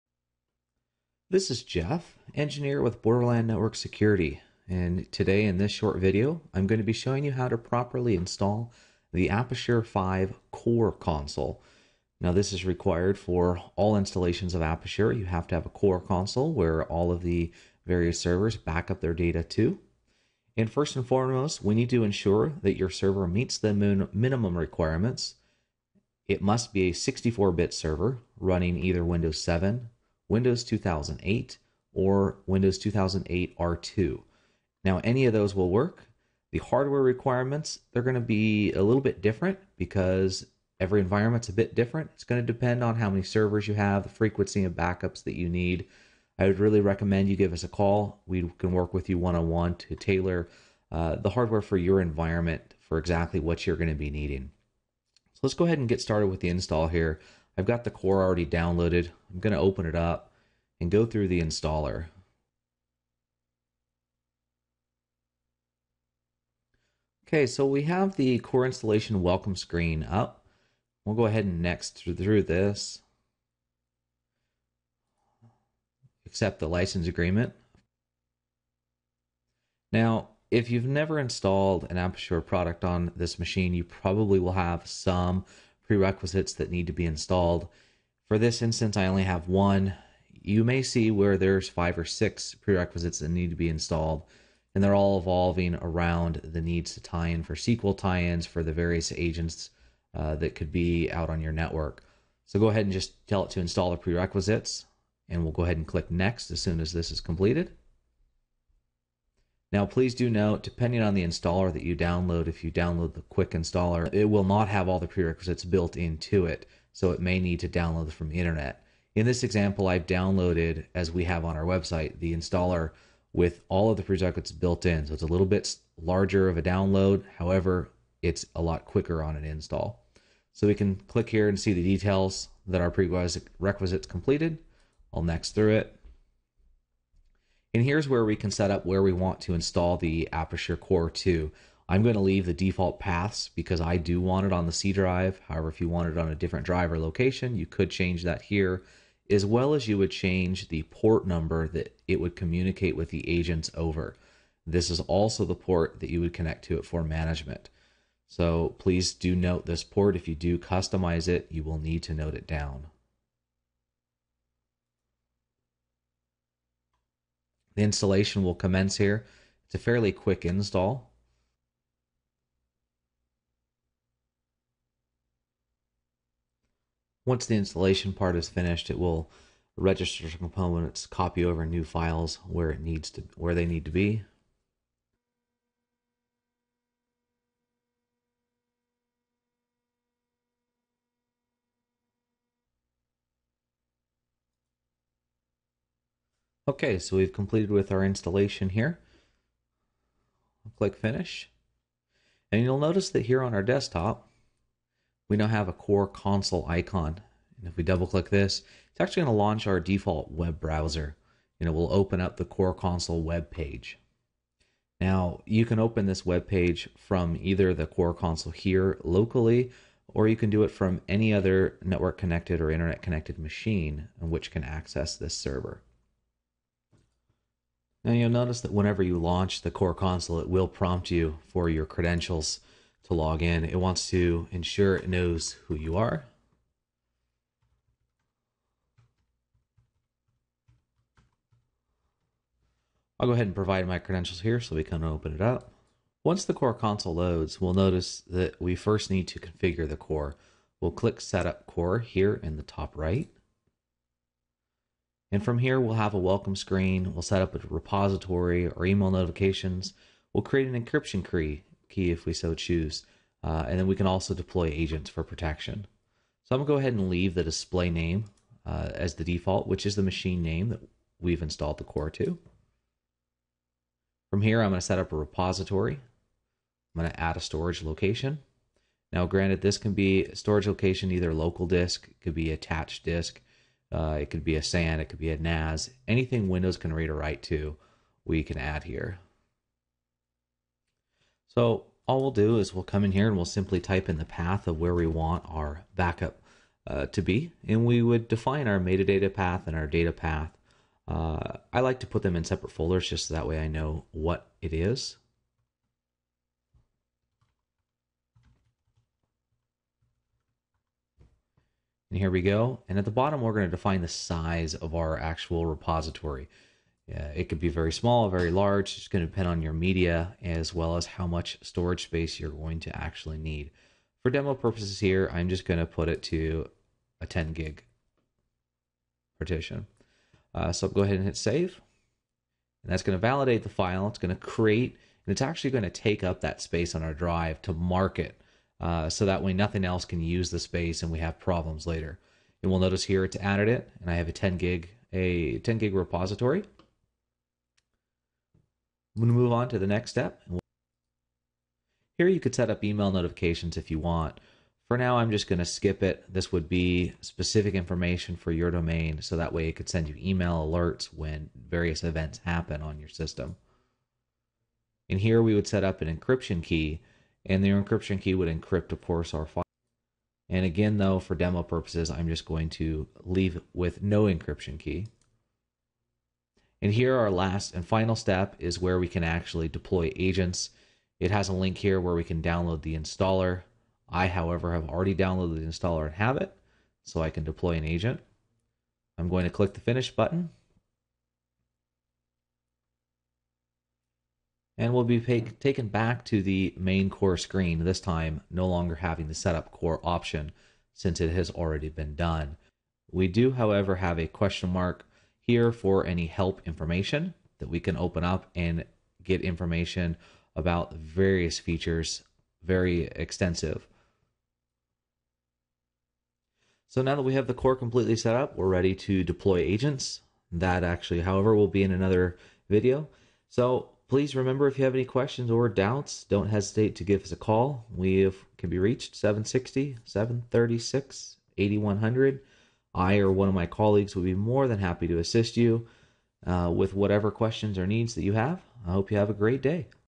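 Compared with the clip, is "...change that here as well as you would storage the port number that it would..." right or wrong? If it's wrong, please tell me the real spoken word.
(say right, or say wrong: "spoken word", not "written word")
wrong: "change", not "storage".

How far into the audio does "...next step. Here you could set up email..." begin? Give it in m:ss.
5:49.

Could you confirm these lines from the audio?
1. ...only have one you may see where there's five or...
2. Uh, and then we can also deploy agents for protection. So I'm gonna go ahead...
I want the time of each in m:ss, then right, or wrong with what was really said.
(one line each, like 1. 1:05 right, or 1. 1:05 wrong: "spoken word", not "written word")
1. 1:29 right
2. 4:23 right.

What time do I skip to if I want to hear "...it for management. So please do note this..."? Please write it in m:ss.
2:36.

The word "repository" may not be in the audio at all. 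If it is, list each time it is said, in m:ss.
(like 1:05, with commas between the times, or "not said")
4:17, 4:35, 5:15, 5:45.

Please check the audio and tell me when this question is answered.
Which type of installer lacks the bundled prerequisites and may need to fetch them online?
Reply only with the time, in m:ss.
1:53.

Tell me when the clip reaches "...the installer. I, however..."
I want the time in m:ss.
6:22.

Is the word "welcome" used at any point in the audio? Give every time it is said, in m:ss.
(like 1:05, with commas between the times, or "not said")
1:09, 4:16.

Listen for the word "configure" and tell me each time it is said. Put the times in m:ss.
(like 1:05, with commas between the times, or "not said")
4:09.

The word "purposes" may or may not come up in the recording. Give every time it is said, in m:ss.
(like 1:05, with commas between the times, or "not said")
5:24, 6:11.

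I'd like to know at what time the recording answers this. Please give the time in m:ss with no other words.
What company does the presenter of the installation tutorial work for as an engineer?
0:03.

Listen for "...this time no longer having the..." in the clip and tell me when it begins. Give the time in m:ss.
6:37.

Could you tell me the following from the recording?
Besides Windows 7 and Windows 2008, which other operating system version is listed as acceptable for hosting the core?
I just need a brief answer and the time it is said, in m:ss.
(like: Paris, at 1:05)
Windows 2008 R2, at 0:32.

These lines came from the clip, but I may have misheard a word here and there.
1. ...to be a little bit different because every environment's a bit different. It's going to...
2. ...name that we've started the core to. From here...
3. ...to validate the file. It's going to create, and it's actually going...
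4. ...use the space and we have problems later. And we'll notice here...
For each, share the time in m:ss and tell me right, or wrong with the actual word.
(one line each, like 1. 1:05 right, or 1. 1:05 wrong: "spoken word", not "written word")
1. 0:38 right
2. 4:30 wrong: "installed", not "started"
3. 5:33 right
4. 5:40 right.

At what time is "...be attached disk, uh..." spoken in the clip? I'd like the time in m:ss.
4:42.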